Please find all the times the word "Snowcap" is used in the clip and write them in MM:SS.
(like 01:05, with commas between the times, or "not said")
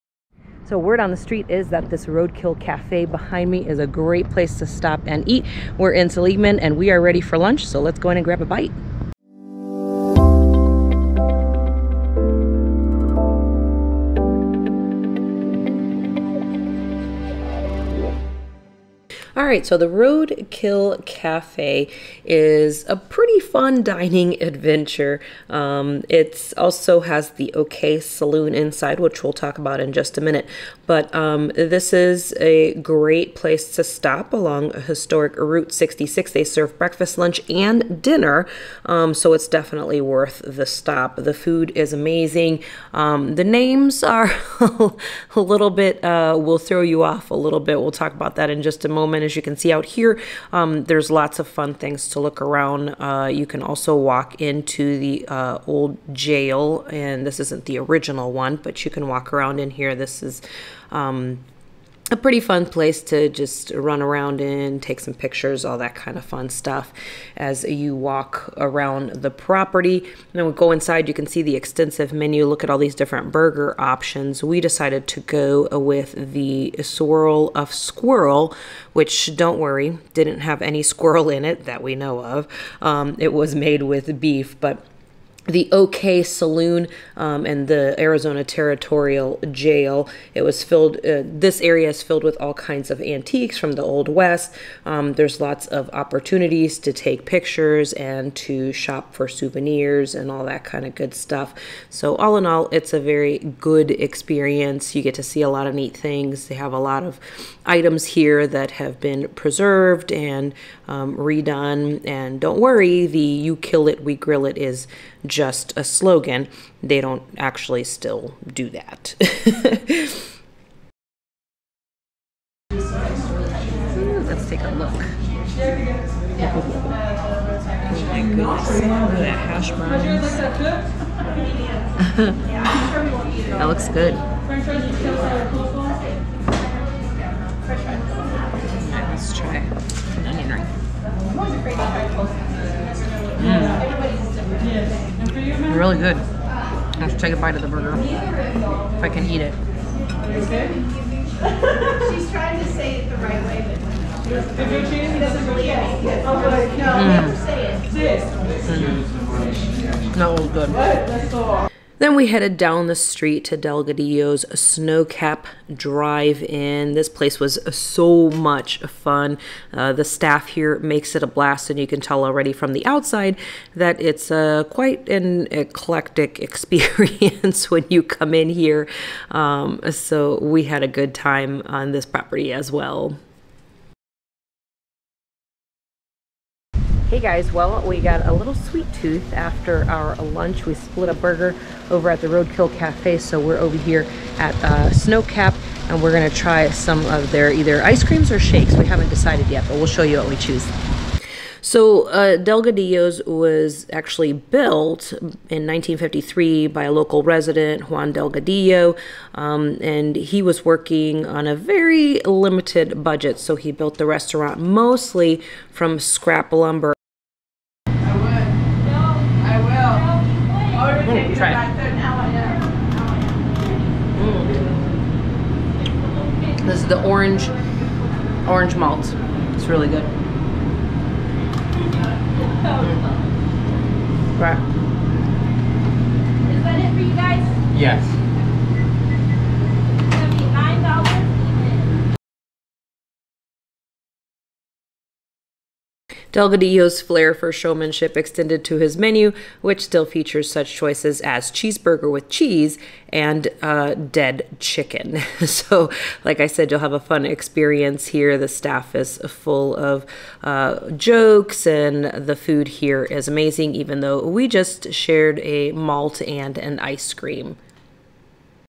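02:44, 03:14.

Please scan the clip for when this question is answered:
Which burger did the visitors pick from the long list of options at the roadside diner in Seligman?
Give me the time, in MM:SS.
01:16.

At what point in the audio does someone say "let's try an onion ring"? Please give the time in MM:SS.
02:19.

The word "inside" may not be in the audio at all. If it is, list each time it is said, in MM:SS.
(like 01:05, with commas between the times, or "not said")
00:28, 01:10.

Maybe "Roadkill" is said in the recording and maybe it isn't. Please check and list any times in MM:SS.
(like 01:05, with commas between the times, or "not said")
00:02, 00:19, 03:12.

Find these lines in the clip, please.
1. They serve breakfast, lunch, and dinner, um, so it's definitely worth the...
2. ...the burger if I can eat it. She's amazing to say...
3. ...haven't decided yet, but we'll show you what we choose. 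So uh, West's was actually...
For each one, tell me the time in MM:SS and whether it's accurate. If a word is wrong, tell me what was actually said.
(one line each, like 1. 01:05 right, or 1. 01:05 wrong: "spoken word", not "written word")
1. 00:36 right
2. 02:27 wrong: "trying", not "amazing"
3. 03:18 wrong: "Delgadillo", not "West".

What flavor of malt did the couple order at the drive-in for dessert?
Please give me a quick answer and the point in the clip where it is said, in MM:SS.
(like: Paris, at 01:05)
Orange, at 03:48.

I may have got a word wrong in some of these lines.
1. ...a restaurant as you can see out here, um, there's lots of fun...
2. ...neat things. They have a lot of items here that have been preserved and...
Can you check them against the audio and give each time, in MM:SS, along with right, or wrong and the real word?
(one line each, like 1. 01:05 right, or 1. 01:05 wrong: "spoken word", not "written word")
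1. 00:48 wrong: "moment", not "restaurant"
2. 01:45 right.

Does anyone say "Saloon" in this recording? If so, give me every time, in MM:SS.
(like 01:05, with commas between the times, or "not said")
00:28, 01:26.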